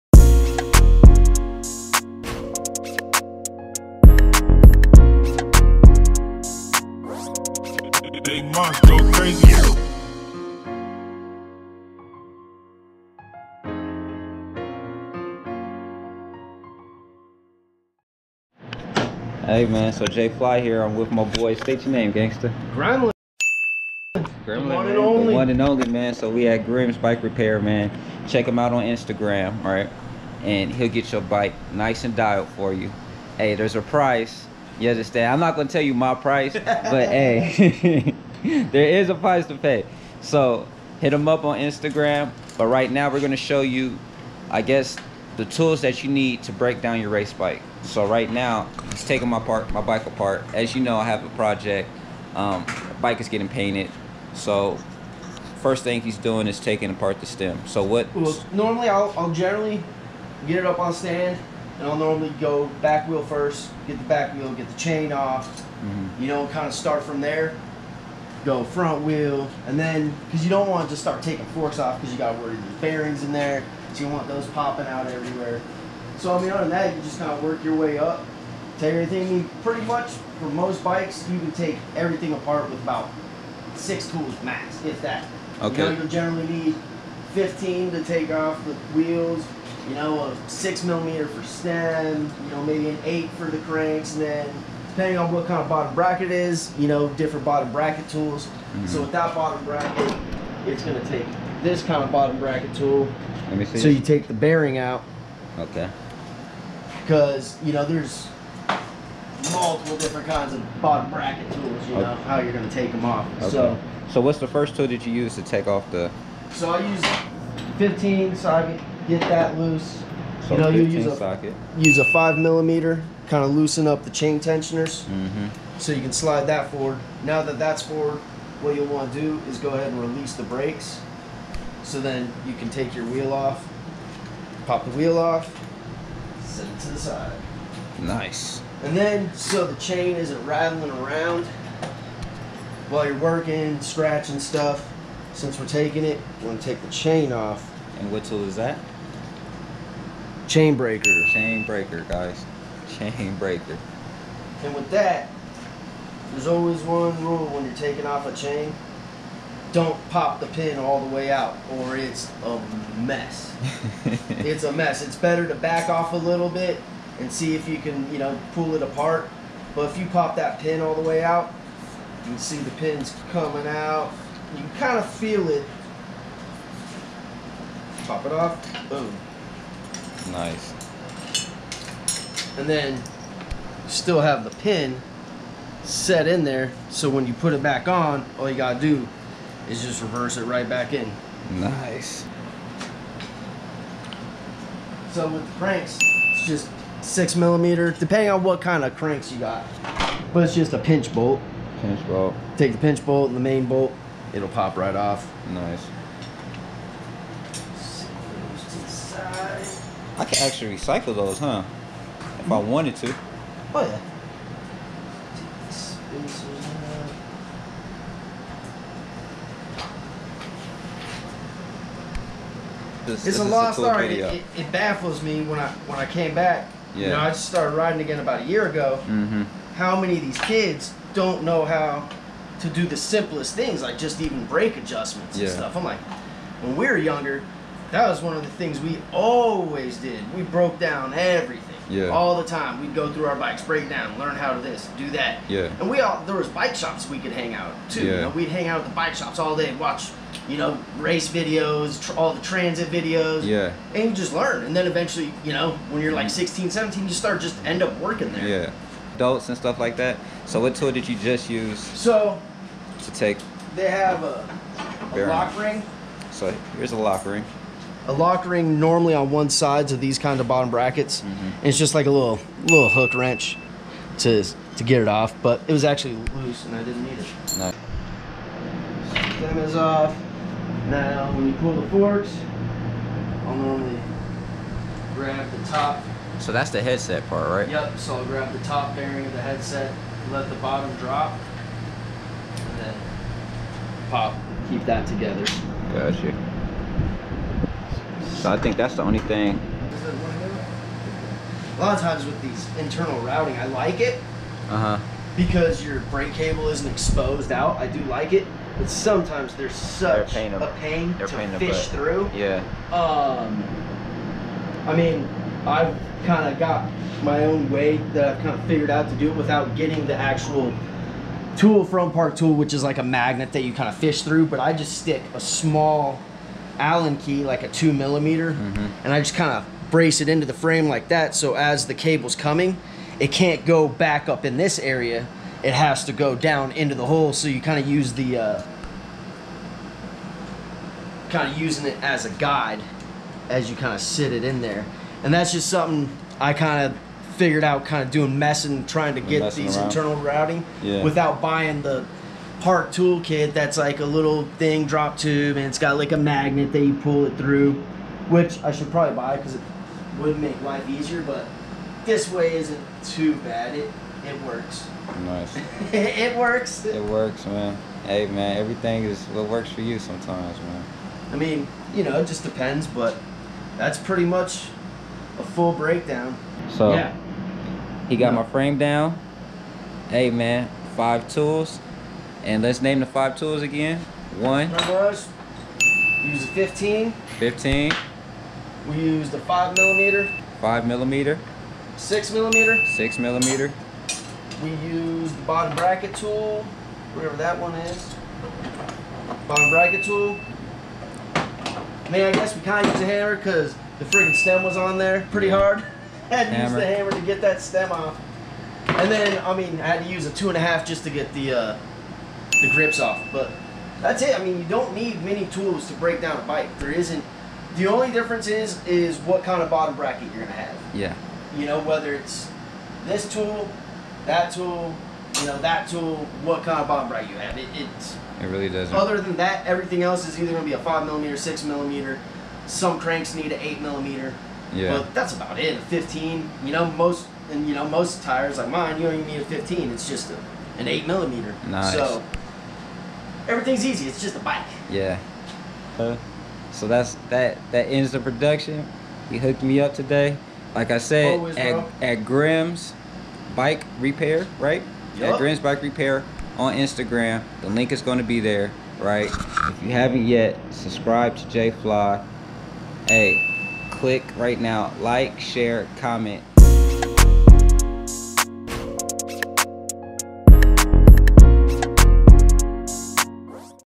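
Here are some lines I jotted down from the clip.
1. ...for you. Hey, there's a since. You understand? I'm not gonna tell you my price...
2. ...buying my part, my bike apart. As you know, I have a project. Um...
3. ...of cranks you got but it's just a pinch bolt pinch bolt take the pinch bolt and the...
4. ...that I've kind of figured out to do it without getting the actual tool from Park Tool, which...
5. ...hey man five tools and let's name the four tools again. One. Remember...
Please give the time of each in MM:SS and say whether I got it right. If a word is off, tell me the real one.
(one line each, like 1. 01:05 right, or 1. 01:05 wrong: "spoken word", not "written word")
1. 00:32 wrong: "price", not "since"
2. 00:49 wrong: "taking", not "buying"
3. 03:18 right
4. 05:18 right
5. 06:20 wrong: "five", not "four".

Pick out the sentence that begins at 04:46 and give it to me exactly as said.
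So that's the headset part, right?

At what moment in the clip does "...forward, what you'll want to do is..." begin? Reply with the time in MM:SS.
02:07.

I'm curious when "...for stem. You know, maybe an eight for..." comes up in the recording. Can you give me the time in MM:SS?
01:31.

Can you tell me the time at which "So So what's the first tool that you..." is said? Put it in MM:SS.
01:53.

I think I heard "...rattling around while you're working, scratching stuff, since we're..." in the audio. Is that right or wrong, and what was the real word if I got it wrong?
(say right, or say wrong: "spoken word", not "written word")
right.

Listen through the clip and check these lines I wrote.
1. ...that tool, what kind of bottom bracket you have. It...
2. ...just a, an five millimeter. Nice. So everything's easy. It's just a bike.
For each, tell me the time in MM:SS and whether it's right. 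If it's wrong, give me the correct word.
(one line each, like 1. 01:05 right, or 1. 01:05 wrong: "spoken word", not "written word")
1. 07:05 right
2. 07:20 wrong: "eight", not "five".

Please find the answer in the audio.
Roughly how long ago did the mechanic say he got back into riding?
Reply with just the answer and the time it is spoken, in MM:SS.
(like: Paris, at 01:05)
About a year ago, at 03:48.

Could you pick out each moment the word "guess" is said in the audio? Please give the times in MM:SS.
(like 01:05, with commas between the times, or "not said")
00:44, 06:42.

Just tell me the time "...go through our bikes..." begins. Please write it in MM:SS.
04:02.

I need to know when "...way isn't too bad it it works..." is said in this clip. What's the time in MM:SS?
06:02.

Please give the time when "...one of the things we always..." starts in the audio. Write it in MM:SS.
03:58.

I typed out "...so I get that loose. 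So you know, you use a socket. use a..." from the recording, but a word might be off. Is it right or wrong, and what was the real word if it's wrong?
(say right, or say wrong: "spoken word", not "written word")
right.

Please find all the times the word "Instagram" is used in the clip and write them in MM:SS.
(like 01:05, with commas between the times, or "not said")
00:28, 00:41, 07:36.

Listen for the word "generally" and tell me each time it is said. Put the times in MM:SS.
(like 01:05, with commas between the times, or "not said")
00:59, 01:26.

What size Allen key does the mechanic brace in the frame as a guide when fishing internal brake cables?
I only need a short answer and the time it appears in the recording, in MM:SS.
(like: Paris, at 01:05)
2 millimeter, at 05:27.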